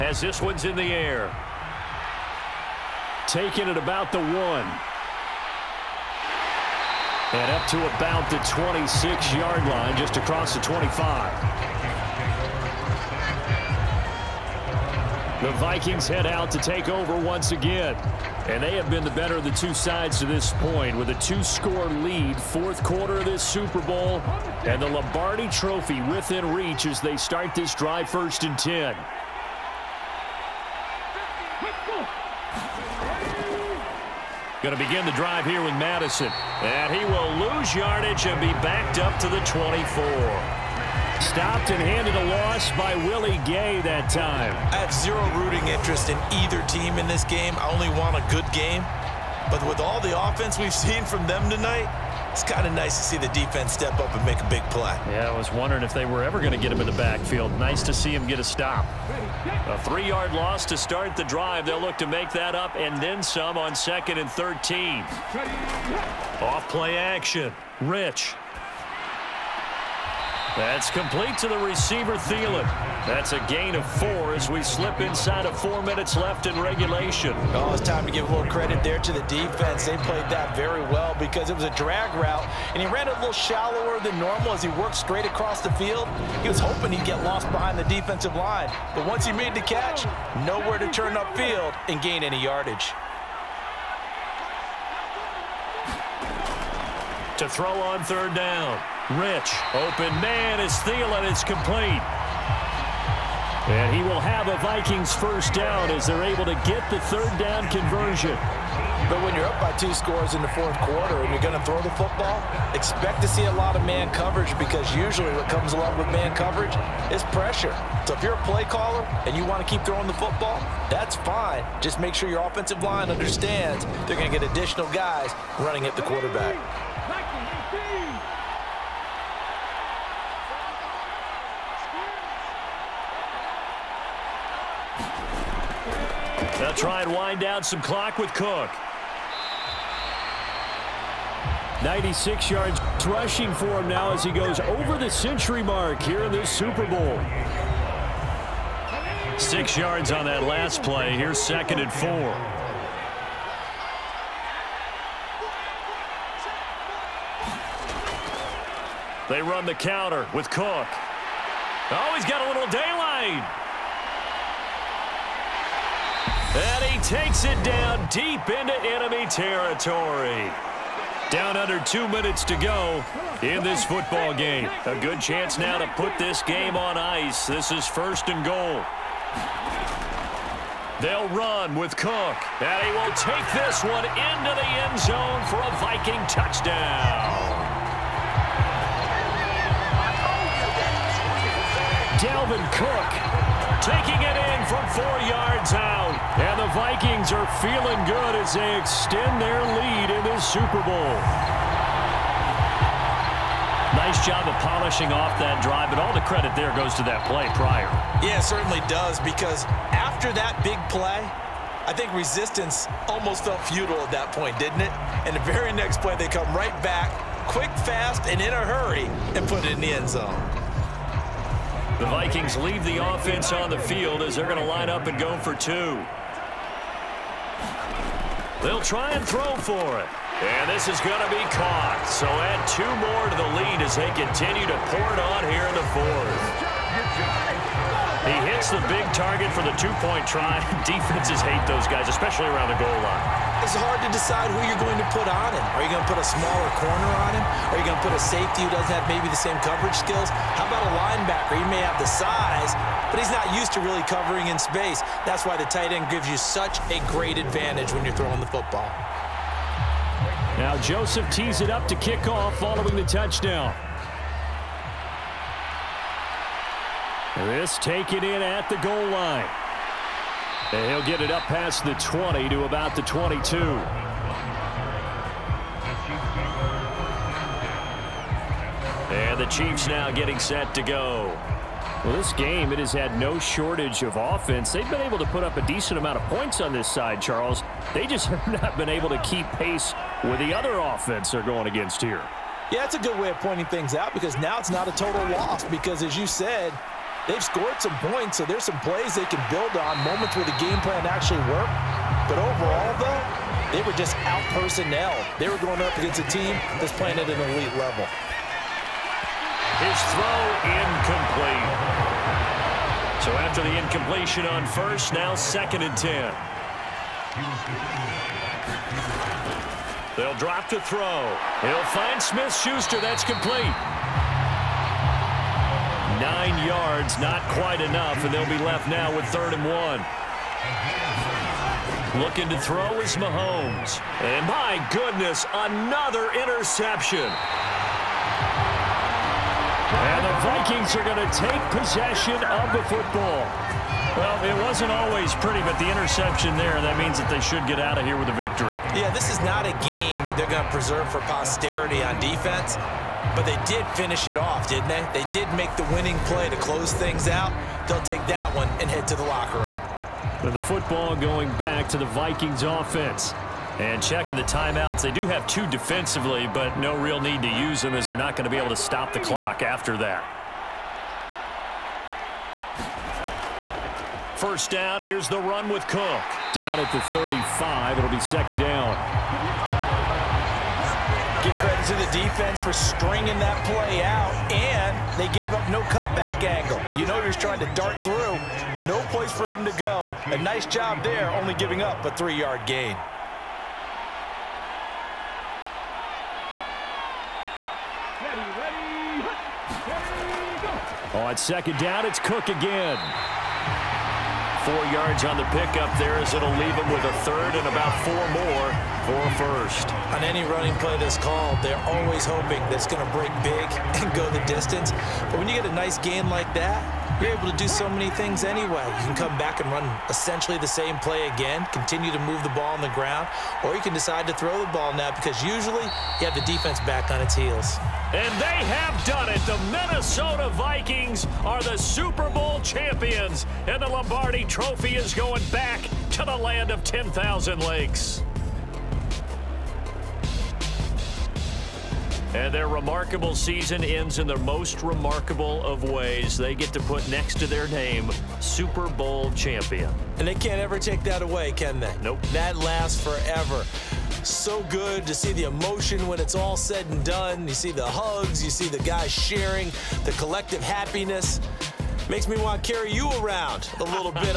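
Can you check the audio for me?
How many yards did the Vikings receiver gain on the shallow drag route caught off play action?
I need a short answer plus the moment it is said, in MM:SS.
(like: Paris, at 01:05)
4, at 01:13.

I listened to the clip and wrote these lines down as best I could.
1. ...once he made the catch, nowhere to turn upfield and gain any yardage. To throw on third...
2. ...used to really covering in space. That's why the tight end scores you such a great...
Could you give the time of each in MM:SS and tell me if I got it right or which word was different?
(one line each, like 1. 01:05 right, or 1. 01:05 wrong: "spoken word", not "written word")
1. 01:29 right
2. 04:13 wrong: "gives", not "scores".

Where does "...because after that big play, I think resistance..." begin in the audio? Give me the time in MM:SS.
03:29.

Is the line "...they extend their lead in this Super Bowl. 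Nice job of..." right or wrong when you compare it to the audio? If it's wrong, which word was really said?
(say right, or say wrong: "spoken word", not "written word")
right.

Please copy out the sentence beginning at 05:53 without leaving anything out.
But they did finish it off, didn't they?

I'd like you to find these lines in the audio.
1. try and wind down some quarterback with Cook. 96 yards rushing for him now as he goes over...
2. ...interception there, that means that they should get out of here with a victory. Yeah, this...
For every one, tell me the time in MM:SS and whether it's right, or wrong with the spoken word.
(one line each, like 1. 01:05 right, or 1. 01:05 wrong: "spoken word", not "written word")
1. 02:16 wrong: "clock", not "quarterback"
2. 05:45 right.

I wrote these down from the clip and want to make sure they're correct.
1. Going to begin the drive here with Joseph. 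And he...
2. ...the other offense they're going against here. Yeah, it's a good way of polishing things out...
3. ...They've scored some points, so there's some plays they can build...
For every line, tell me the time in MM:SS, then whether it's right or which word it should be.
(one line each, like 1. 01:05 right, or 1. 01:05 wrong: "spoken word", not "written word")
1. 00:34 wrong: "Mattison", not "Joseph"
2. 04:50 wrong: "pointing", not "polishing"
3. 04:57 right.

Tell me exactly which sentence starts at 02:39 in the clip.
They run the counter with Cook.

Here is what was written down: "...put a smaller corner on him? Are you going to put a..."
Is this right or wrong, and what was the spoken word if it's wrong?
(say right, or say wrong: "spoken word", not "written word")
right.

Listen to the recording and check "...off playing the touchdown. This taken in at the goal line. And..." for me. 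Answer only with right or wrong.
wrong.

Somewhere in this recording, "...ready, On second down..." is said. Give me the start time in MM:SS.
06:41.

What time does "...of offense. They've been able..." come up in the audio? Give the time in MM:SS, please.
04:44.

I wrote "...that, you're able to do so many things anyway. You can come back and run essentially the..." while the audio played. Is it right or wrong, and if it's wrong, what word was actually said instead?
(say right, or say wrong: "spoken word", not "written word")
right.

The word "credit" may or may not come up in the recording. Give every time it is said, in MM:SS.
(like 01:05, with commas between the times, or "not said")
01:18, 03:26, 06:21.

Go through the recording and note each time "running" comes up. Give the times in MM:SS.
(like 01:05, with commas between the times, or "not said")
02:05, 06:50.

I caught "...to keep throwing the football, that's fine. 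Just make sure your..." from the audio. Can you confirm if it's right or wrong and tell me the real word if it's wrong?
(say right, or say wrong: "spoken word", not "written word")
right.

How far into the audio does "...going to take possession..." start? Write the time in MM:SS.
05:41.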